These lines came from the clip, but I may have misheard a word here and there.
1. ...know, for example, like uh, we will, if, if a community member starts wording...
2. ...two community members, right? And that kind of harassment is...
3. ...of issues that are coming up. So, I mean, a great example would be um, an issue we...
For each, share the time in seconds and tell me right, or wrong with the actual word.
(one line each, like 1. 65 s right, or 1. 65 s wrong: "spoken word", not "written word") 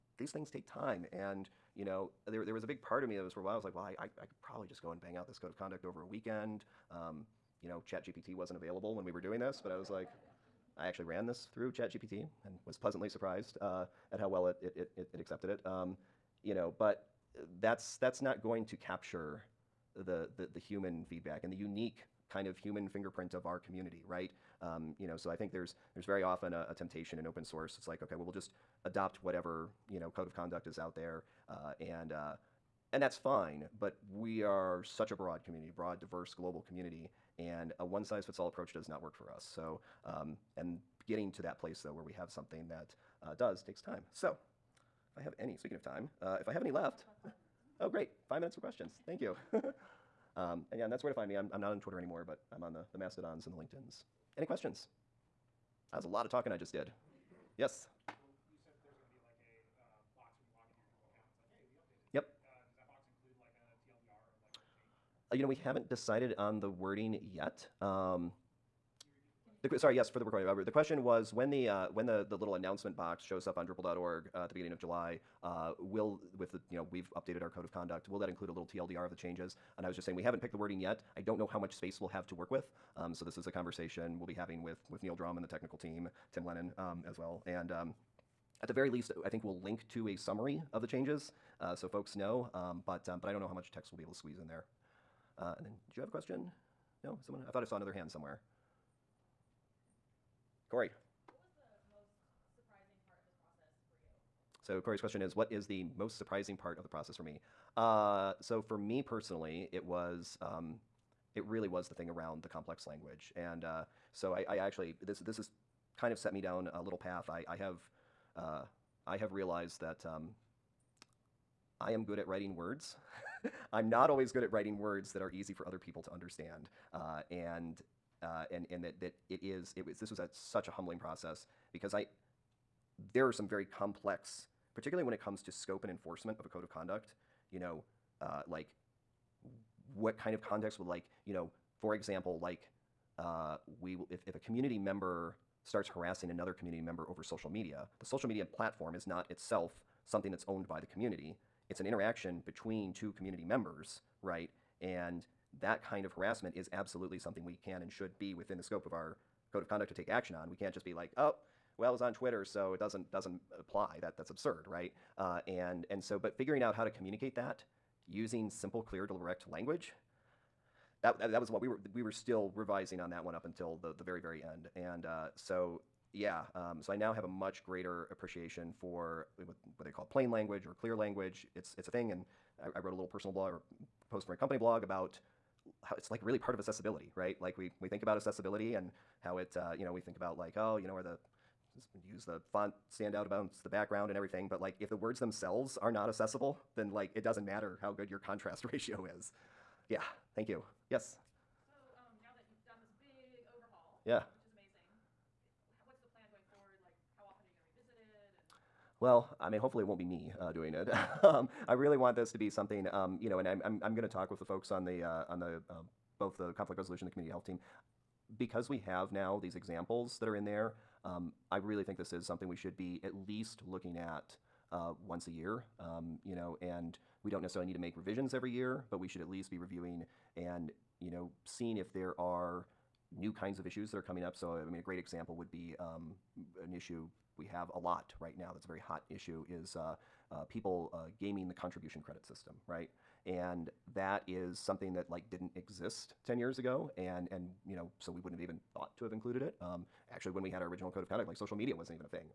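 1. 141 s wrong: "harassing", not "wording"
2. 152 s right
3. 233 s right.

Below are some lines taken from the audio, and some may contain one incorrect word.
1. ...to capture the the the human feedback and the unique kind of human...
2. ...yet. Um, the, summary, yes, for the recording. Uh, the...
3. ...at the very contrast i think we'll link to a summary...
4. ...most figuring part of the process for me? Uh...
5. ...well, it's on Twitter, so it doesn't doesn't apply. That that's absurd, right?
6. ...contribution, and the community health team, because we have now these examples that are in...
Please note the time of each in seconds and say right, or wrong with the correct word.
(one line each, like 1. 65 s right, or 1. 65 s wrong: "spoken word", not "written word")
1. 18 s right
2. 67 s wrong: "sorry", not "summary"
3. 88 s wrong: "least", not "contrast"
4. 105 s wrong: "surprising", not "figuring"
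5. 161 s right
6. 216 s wrong: "resolution", not "contribution".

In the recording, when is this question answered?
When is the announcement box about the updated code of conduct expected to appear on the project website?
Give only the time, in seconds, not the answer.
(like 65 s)
74 s.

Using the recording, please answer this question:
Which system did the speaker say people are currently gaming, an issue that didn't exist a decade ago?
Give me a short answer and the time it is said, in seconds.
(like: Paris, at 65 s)
Contribution credit system, at 241 s.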